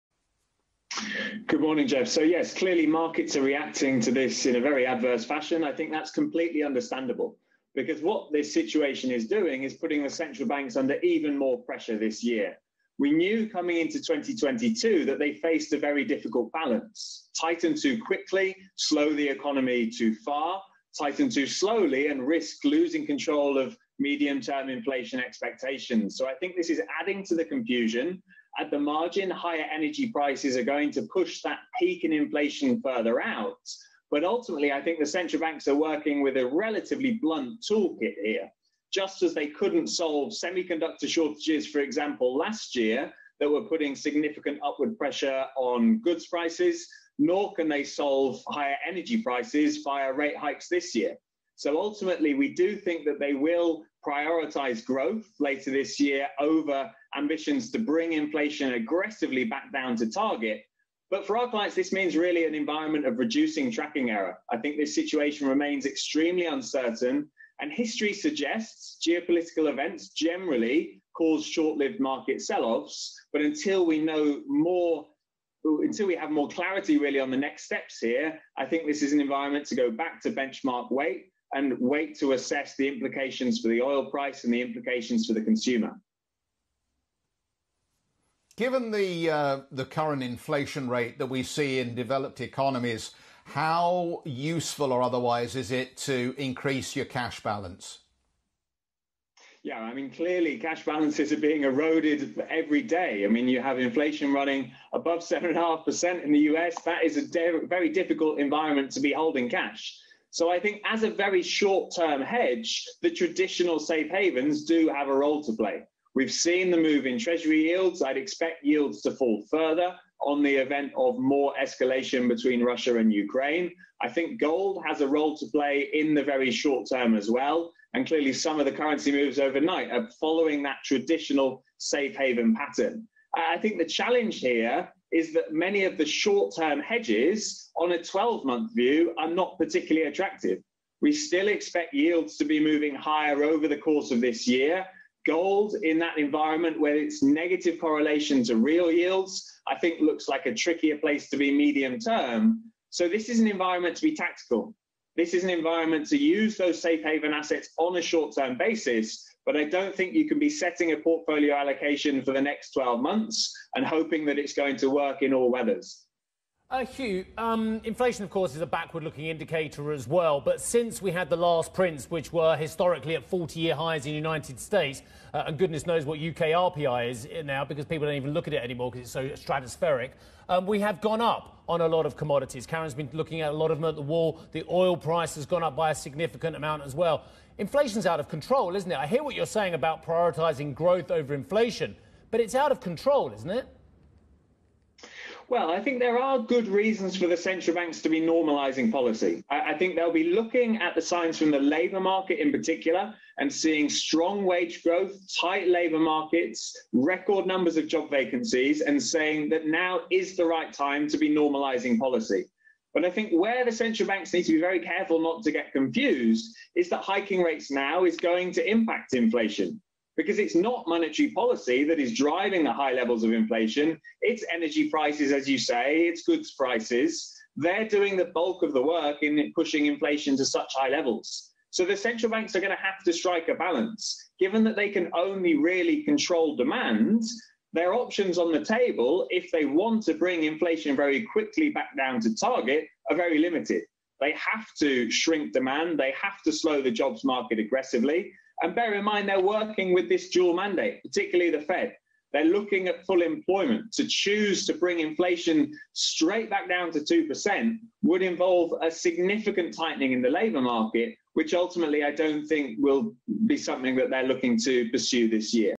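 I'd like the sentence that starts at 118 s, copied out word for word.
I'd expect yields to fall further on the event of more escalation between Russia and Ukraine.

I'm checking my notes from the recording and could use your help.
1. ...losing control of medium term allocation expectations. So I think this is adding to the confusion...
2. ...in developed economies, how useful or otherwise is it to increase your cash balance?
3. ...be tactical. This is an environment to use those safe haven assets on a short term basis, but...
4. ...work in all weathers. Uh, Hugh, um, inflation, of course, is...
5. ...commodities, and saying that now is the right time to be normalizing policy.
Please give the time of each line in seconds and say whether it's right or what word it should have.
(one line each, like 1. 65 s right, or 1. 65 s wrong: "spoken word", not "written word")
1. 22 s wrong: "inflation", not "allocation"
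2. 91 s right
3. 154 s right
4. 164 s right
5. 208 s wrong: "vacancies", not "commodities".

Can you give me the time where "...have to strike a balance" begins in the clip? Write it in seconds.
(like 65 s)
232 s.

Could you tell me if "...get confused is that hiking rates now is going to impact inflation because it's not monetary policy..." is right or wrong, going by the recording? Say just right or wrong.
right.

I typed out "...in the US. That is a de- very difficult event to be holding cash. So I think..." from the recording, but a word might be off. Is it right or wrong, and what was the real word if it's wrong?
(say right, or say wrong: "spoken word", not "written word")
wrong: "environment", not "event".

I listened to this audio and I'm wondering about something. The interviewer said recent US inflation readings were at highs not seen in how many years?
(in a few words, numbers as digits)
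40 years.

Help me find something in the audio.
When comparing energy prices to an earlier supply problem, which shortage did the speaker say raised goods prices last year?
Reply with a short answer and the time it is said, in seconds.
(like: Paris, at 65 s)
Semiconductor shortages, at 40 s.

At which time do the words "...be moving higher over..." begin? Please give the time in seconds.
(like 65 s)
142 s.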